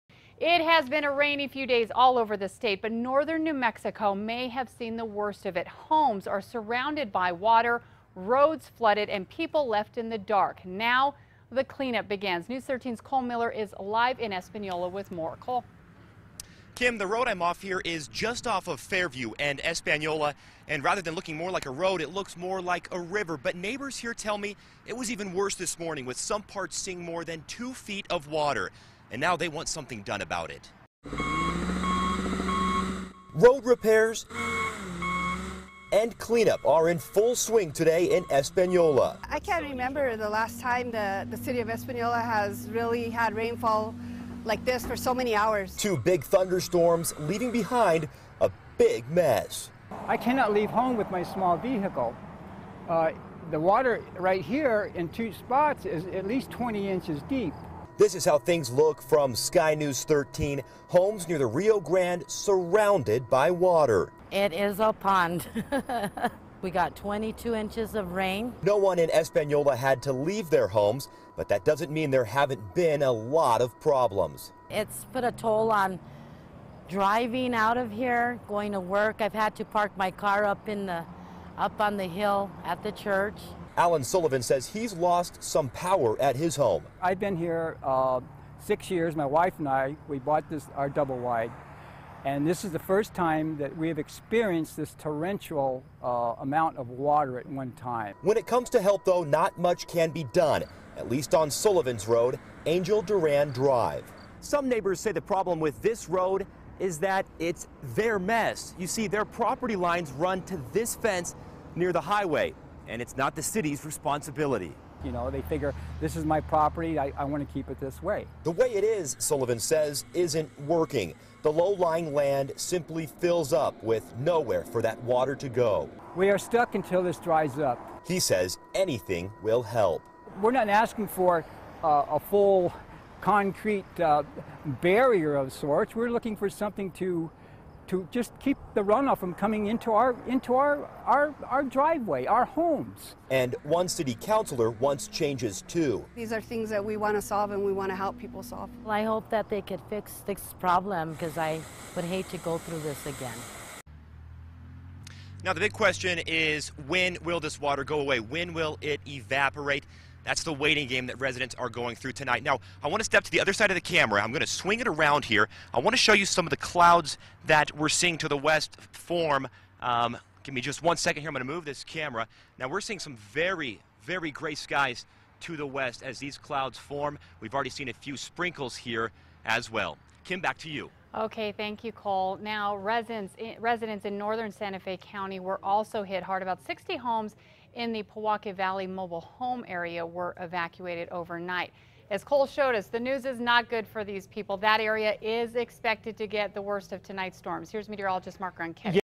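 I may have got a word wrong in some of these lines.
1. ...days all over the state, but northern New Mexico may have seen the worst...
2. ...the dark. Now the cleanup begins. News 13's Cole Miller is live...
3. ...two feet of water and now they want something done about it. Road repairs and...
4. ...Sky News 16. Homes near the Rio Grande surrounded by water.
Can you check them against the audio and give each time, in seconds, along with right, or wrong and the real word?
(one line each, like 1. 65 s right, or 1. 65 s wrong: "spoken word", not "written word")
1. 1 s right
2. 10 s right
3. 27 s right
4. 59 s wrong: "13", not "16".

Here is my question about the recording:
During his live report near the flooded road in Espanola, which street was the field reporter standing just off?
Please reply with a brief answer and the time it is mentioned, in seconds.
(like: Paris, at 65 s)
Fairview, at 18 s.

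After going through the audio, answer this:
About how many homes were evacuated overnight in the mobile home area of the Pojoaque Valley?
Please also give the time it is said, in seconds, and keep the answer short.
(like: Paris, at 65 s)
60, at 186 s.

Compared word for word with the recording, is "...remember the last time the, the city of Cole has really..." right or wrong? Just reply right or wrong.
wrong.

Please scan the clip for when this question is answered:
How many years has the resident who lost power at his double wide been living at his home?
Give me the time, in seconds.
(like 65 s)
88 s.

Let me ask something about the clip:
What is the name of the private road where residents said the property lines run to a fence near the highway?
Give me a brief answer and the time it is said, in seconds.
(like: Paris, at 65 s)
Angel Duran Drive, at 102 s.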